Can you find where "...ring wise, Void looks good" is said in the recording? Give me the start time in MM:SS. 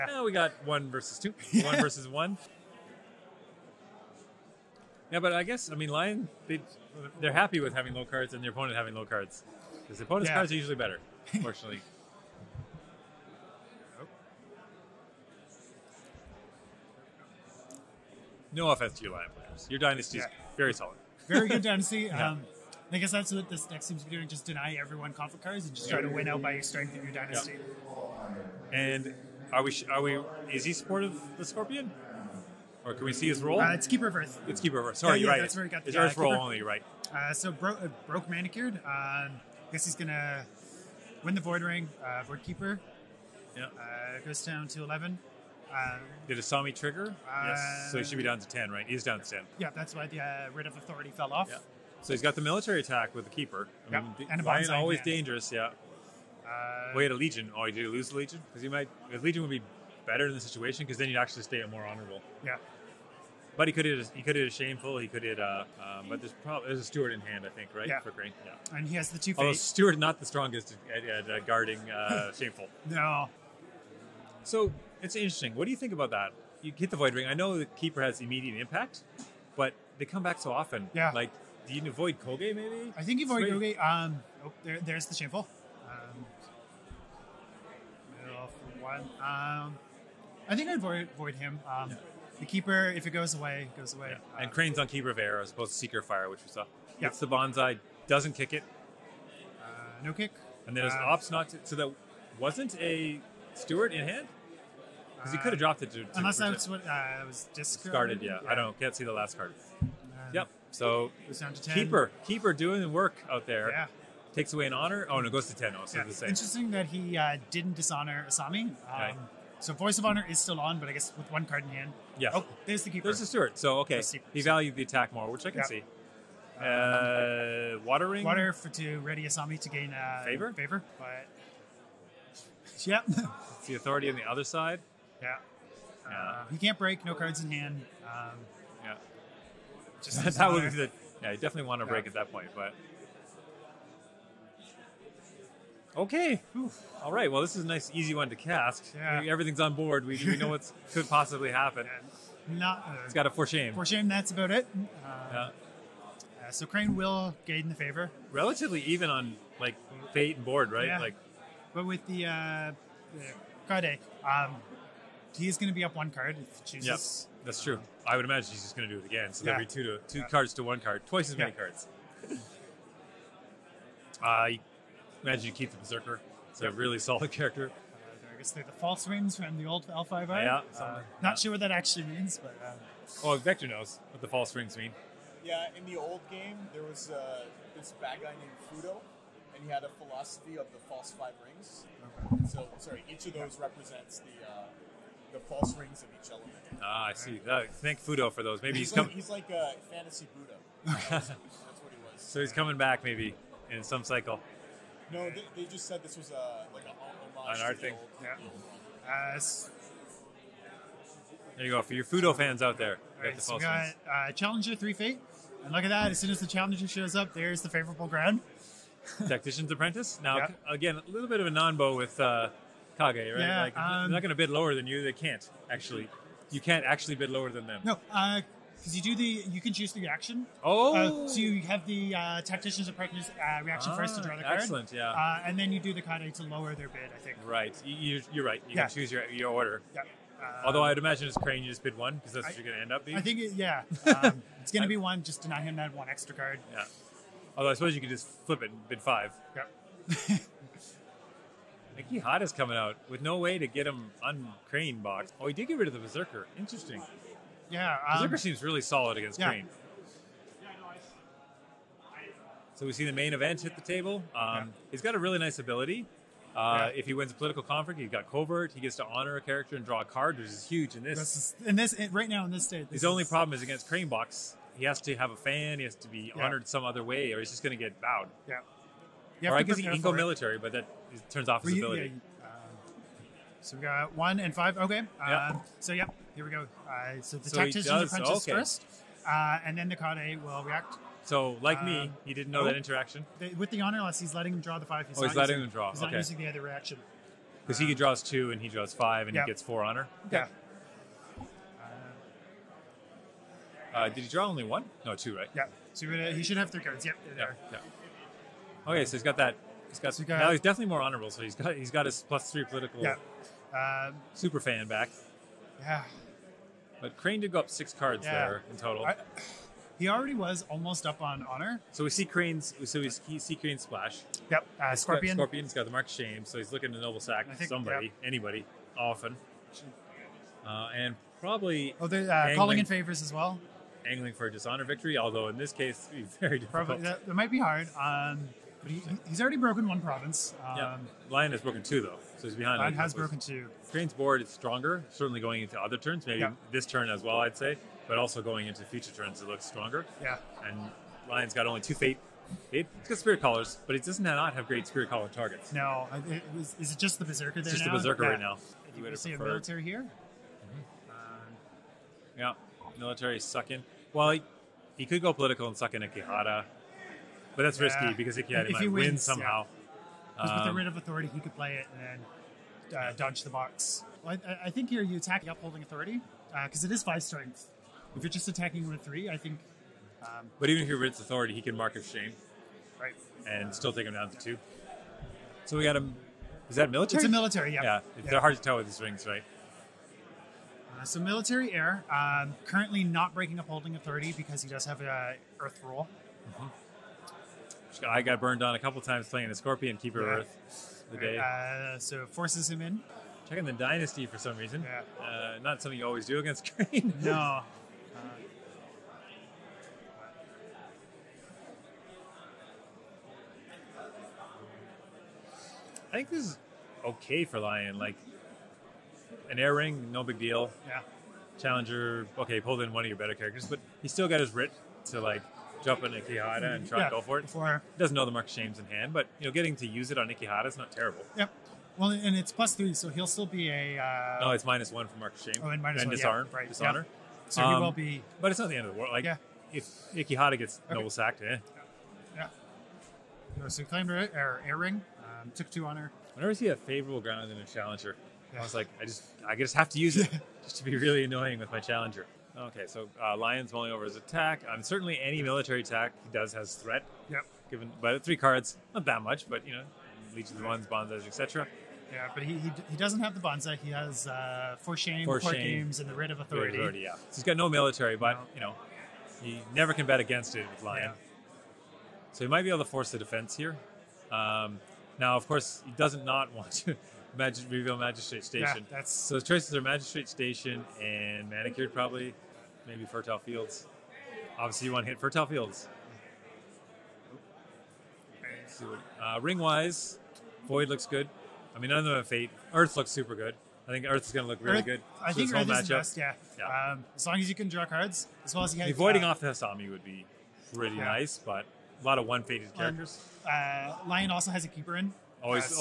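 08:09.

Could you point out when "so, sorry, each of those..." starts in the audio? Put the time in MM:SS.
03:12.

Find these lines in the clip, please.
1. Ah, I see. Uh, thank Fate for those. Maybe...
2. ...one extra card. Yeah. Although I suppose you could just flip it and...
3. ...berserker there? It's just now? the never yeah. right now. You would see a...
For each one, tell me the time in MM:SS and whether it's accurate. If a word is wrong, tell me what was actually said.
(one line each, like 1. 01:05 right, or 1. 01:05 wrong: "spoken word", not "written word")
1. 03:16 wrong: "Fudo", not "Fate"
2. 04:05 right
3. 05:57 wrong: "berserker", not "never".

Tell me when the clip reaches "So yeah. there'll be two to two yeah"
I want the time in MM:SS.
02:49.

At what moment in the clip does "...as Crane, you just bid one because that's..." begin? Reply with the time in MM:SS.
04:01.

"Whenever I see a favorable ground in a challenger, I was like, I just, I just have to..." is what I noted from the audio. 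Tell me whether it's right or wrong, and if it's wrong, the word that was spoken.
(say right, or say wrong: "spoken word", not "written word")
right.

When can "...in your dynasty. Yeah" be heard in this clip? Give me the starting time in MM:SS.
00:26.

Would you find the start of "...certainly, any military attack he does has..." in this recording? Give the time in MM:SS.
07:34.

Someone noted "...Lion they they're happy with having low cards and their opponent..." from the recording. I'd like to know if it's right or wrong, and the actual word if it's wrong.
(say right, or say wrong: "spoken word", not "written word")
right.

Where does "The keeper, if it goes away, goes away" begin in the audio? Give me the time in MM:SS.
01:32.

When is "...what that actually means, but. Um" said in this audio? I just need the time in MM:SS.
03:01.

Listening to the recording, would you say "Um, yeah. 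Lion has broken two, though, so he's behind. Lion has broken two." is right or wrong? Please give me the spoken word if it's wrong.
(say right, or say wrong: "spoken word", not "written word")
right.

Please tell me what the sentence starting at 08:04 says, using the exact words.
Obviously, you want to hit fertile fields.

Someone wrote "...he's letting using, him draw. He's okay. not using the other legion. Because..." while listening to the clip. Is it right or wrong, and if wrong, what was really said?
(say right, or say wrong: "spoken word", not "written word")
wrong: "reaction", not "legion".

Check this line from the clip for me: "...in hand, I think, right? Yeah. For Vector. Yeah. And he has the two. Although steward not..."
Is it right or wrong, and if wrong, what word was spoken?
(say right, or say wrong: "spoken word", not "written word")
wrong: "Crane", not "Vector".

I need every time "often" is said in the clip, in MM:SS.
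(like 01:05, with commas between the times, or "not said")
01:20, 05:28.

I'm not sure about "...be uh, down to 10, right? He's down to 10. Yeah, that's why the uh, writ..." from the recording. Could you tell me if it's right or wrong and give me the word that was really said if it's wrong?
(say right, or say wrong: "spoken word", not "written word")
right.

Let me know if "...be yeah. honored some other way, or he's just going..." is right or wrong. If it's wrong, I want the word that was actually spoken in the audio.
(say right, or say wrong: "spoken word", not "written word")
right.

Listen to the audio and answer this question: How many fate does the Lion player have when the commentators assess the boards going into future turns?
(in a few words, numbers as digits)
2.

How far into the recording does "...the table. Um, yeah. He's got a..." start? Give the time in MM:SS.
04:23.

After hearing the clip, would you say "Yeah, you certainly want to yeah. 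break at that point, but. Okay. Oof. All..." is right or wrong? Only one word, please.
wrong.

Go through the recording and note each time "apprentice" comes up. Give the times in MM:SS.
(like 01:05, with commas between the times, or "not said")
03:39, 03:52, 04:48.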